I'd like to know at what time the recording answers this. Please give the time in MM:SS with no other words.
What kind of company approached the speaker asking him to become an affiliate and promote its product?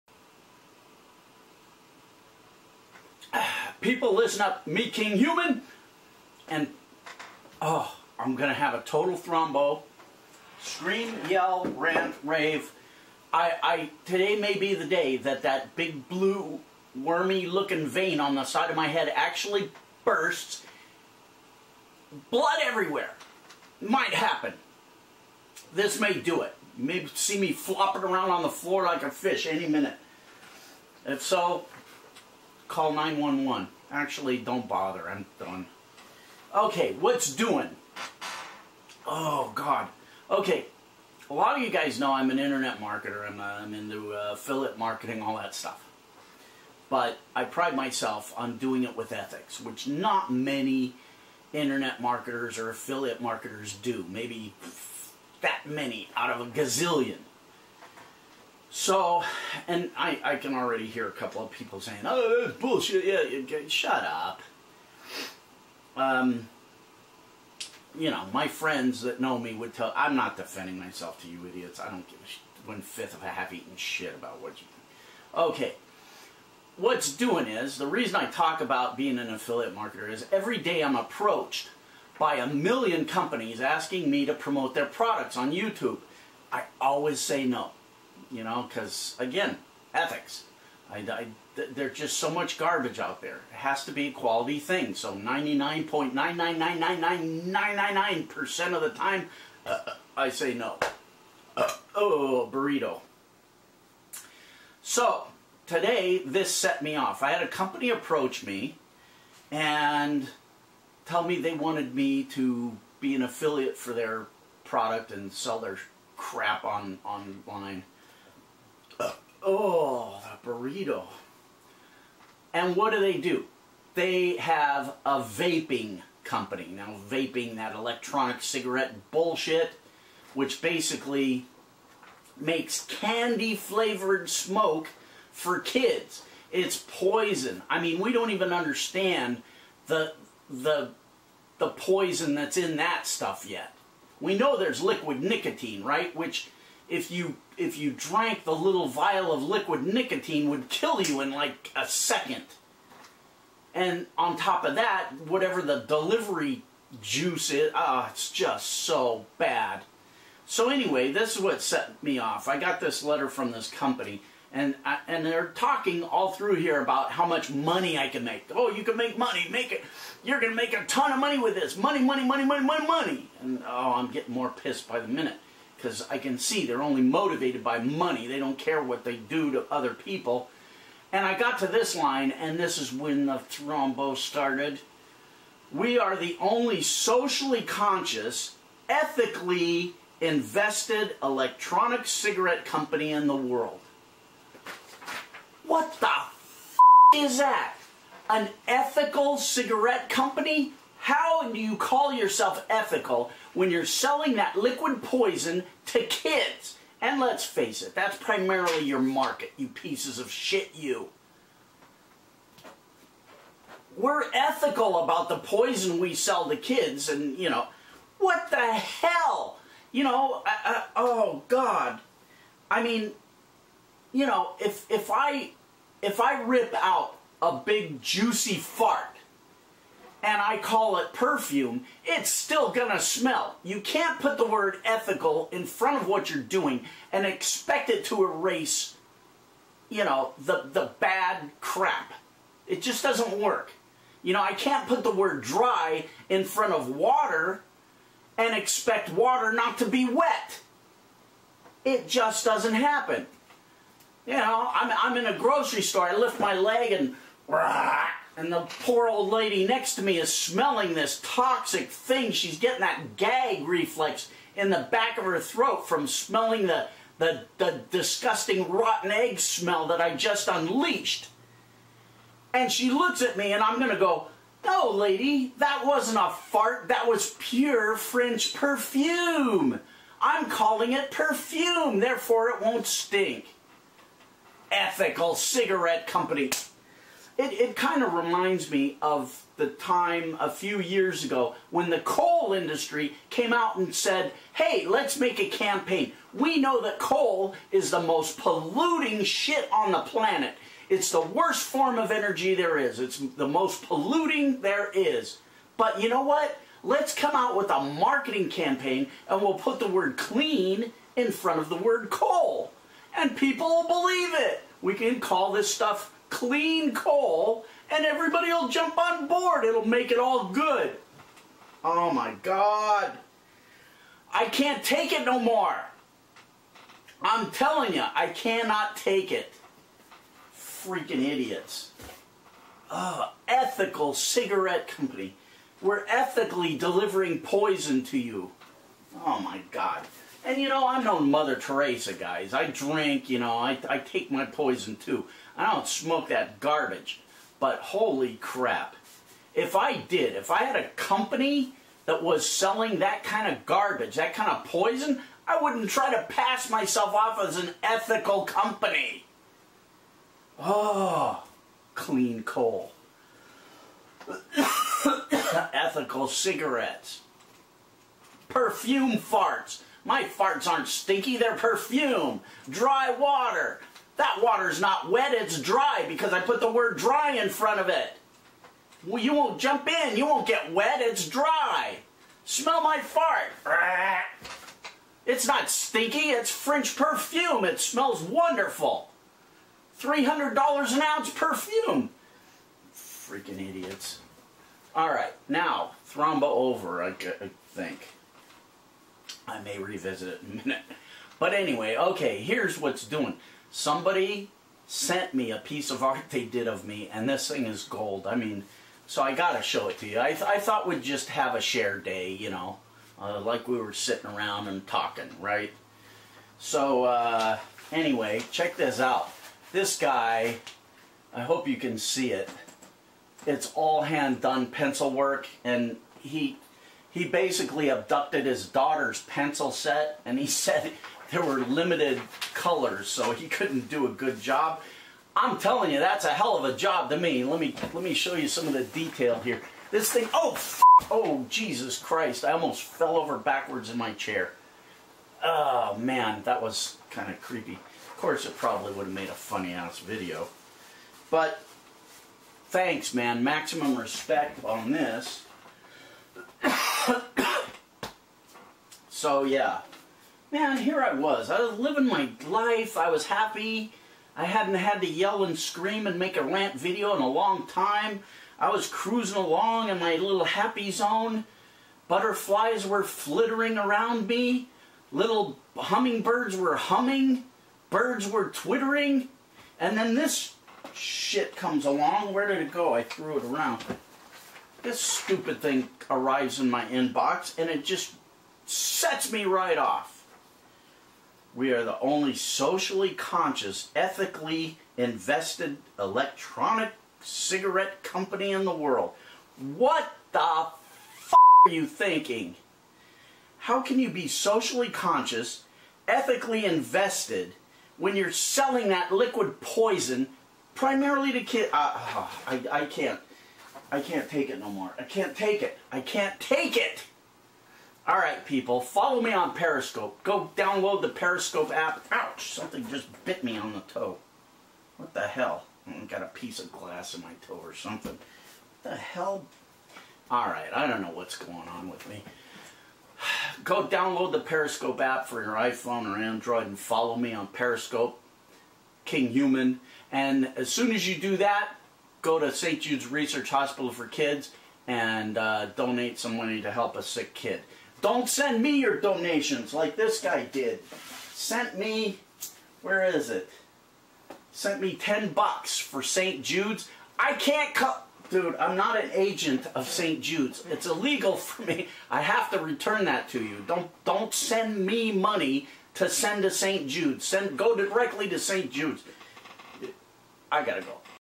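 02:05.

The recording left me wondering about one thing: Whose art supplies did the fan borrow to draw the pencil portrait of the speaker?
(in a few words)
his daughter's.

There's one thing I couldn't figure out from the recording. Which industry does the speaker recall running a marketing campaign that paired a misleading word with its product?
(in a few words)
coal industry.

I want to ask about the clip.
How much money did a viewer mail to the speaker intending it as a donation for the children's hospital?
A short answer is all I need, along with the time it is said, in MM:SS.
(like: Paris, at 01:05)
$10, at 09:14.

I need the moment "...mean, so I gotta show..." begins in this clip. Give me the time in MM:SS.
06:48.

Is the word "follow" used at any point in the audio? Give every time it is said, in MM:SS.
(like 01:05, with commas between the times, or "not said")
08:38, 08:56.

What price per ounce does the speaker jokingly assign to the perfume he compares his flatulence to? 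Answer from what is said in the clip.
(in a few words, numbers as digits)
$300.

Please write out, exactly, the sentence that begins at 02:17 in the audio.
I mean, we don't even understand the the the poison that's in that stuff yet.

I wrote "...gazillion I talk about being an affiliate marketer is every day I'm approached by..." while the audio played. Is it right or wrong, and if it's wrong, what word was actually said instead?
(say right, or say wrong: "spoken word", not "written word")
wrong: "reason", not "gazillion".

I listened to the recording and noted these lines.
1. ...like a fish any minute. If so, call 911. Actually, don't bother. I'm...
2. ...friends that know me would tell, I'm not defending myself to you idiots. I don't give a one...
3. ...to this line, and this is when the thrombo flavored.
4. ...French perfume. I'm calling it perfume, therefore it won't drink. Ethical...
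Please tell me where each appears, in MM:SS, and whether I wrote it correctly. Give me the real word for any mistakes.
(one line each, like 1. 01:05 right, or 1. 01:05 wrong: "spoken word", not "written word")
1. 00:28 right
2. 01:08 right
3. 03:01 wrong: "started", not "flavored"
4. 04:37 wrong: "stink", not "drink".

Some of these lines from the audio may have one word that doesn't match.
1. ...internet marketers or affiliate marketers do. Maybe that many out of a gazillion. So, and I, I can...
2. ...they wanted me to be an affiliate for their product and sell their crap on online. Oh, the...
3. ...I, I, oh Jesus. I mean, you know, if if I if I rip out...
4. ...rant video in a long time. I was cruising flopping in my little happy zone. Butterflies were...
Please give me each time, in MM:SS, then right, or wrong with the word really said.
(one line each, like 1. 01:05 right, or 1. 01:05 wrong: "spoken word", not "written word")
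1. 00:51 right
2. 01:51 right
3. 03:40 wrong: "God", not "Jesus"
4. 07:46 wrong: "along", not "flopping".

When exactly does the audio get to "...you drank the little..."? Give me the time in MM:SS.
02:27.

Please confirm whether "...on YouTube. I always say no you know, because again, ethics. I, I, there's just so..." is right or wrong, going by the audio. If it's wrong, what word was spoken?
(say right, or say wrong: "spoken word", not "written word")
right.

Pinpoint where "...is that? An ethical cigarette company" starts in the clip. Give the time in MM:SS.
03:17.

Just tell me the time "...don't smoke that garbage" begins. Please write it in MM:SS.
05:45.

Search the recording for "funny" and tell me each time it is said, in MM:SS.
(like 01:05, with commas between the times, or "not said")
07:29.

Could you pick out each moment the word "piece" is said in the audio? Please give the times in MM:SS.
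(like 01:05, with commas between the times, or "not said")
03:29, 06:45, 08:46.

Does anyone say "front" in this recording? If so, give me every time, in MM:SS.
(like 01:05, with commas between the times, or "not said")
03:55, 04:06, 05:11, 06:17.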